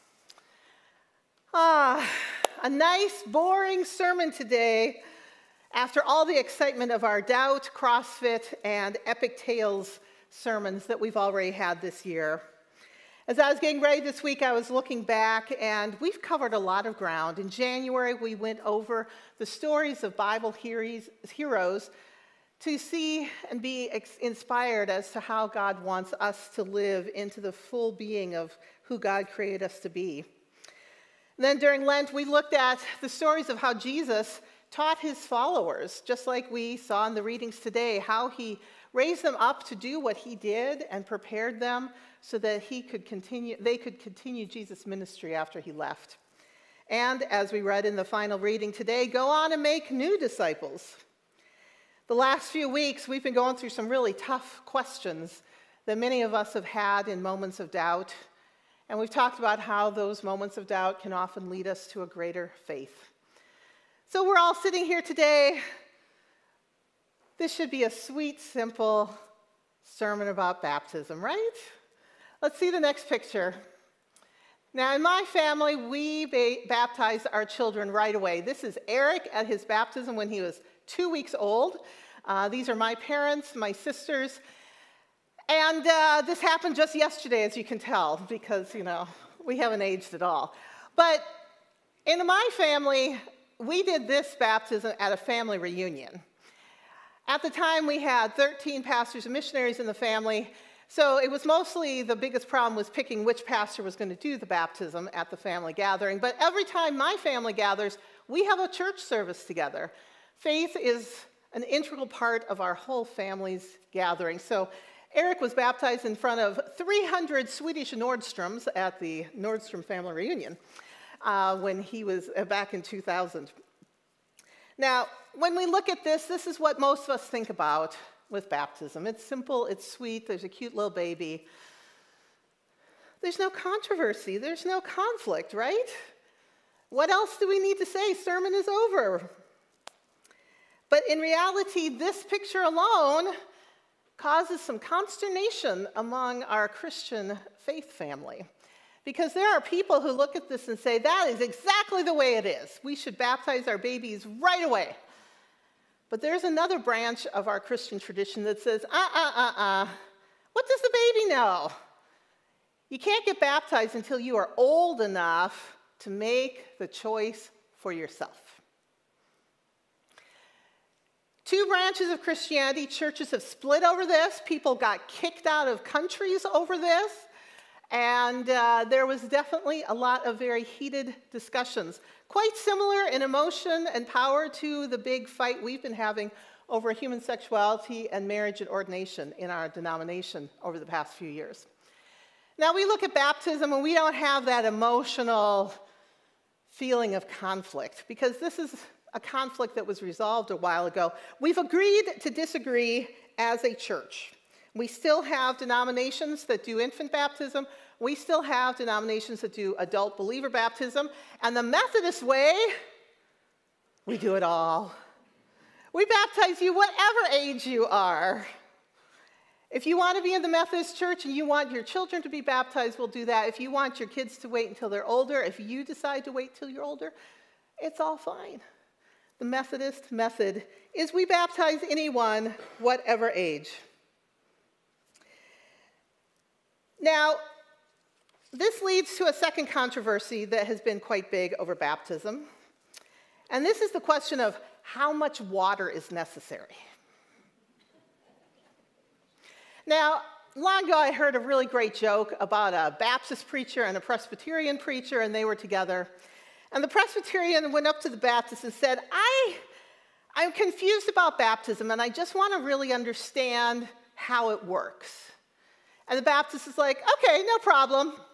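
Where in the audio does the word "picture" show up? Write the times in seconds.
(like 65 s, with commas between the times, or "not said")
73 s, 142 s.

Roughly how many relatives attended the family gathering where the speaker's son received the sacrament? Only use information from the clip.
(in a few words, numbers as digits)
300.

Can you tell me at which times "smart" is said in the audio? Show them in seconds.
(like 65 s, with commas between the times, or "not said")
not said.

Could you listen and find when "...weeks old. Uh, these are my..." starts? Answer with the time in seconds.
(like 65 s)
81 s.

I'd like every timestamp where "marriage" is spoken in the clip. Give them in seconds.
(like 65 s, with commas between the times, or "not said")
188 s.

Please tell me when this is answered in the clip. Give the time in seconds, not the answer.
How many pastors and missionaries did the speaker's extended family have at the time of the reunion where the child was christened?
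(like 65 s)
98 s.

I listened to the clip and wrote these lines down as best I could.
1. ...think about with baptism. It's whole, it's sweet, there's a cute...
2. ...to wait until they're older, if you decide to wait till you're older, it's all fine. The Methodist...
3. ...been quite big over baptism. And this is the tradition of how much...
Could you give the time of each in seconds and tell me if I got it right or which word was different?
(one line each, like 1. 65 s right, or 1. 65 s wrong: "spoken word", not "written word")
1. 127 s wrong: "simple", not "whole"
2. 224 s right
3. 240 s wrong: "question", not "tradition".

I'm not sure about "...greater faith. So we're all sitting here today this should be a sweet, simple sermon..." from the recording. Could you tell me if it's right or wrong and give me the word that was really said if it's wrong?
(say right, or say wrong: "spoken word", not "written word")
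right.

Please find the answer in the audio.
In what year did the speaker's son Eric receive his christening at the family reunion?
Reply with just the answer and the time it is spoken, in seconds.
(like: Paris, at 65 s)
2000, at 122 s.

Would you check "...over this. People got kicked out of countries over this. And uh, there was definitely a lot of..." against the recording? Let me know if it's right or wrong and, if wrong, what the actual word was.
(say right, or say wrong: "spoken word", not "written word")
right.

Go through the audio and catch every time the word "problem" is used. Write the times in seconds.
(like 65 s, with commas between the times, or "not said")
102 s, 267 s.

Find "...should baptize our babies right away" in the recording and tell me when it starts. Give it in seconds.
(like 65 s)
152 s.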